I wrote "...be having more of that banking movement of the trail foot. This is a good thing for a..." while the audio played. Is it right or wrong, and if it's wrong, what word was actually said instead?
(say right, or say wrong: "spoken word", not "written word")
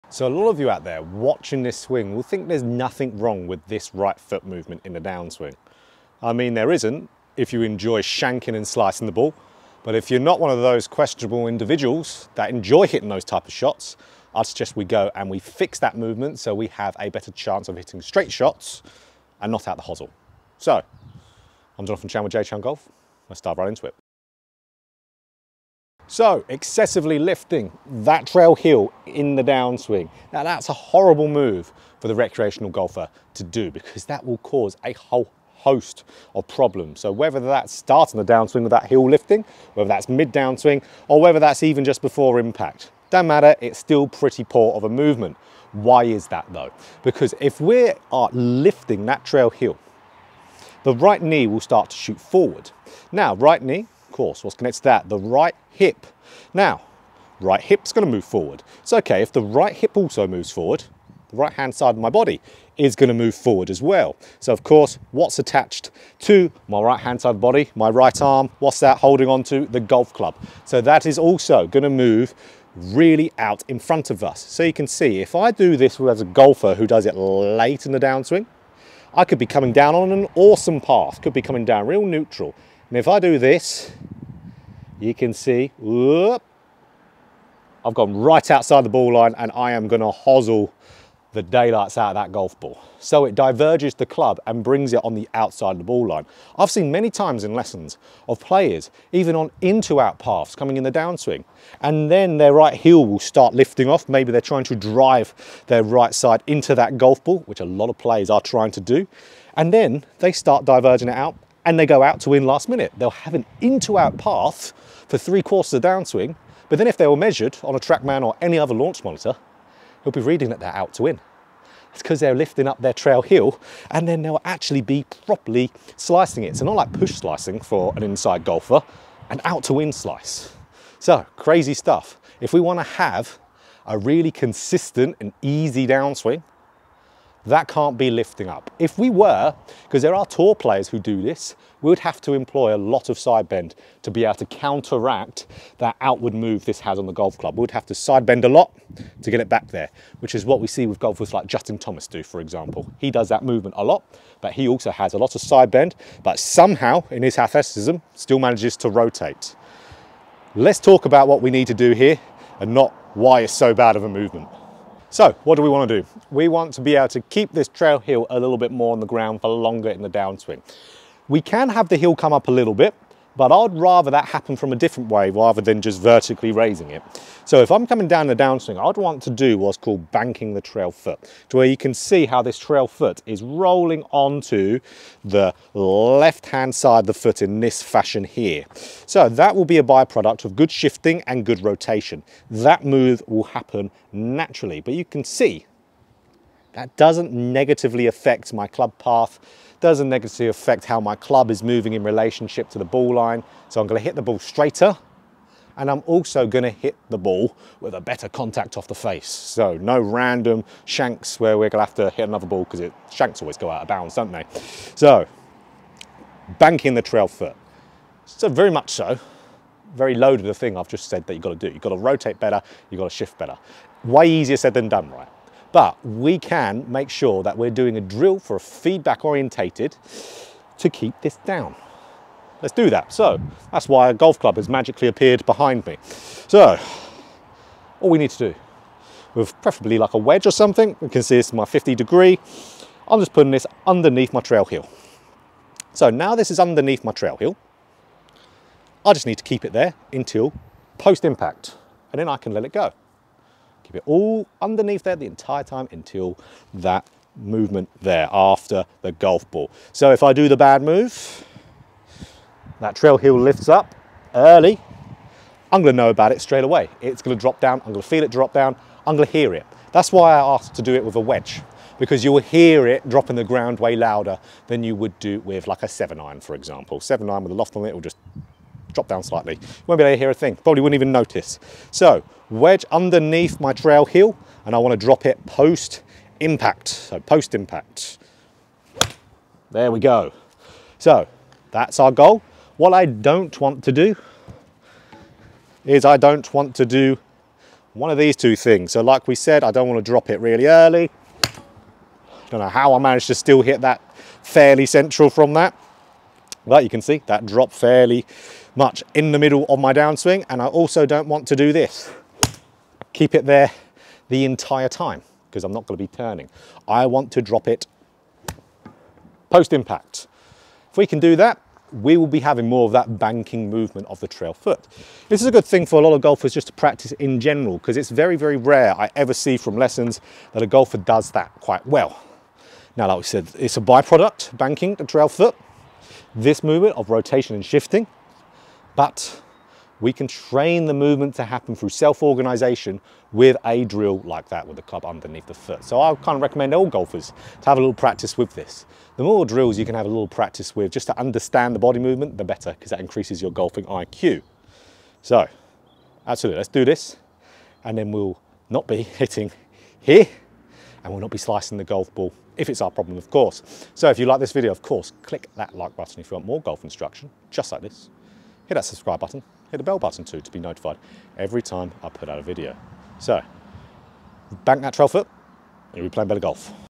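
right.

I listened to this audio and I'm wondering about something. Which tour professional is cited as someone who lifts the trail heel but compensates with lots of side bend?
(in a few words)
Justin Thomas.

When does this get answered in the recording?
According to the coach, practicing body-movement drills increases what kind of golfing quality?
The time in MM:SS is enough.
05:53.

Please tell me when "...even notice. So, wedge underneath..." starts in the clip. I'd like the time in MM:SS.
04:40.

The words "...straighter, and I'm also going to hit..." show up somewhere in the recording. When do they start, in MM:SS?
03:24.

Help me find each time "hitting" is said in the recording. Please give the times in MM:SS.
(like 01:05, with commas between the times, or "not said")
00:12, 00:17, 05:59.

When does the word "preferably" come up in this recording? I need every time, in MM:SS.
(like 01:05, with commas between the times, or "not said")
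03:59.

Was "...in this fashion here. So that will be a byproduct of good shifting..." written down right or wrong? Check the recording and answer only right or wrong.
right.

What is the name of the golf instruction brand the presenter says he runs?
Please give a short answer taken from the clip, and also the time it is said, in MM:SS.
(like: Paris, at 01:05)
J Chown Golf, at 00:22.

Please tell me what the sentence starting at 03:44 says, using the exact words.
Way easier said than done, right?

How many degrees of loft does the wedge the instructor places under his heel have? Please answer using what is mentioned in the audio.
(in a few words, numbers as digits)
50.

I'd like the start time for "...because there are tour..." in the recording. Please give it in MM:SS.
02:19.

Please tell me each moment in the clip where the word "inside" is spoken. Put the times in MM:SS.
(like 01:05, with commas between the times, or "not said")
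02:08.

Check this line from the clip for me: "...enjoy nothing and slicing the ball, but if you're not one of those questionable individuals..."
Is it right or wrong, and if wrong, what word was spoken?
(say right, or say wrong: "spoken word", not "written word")
wrong: "shanking", not "nothing".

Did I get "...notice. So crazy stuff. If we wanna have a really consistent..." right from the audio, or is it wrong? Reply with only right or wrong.
wrong.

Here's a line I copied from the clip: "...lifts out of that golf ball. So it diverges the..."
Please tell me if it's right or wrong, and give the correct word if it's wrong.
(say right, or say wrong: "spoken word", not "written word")
wrong: "daylights", not "lifts".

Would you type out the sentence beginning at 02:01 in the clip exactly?
It's because they're lifting up their trail heel and then they'll actually be properly slicing it.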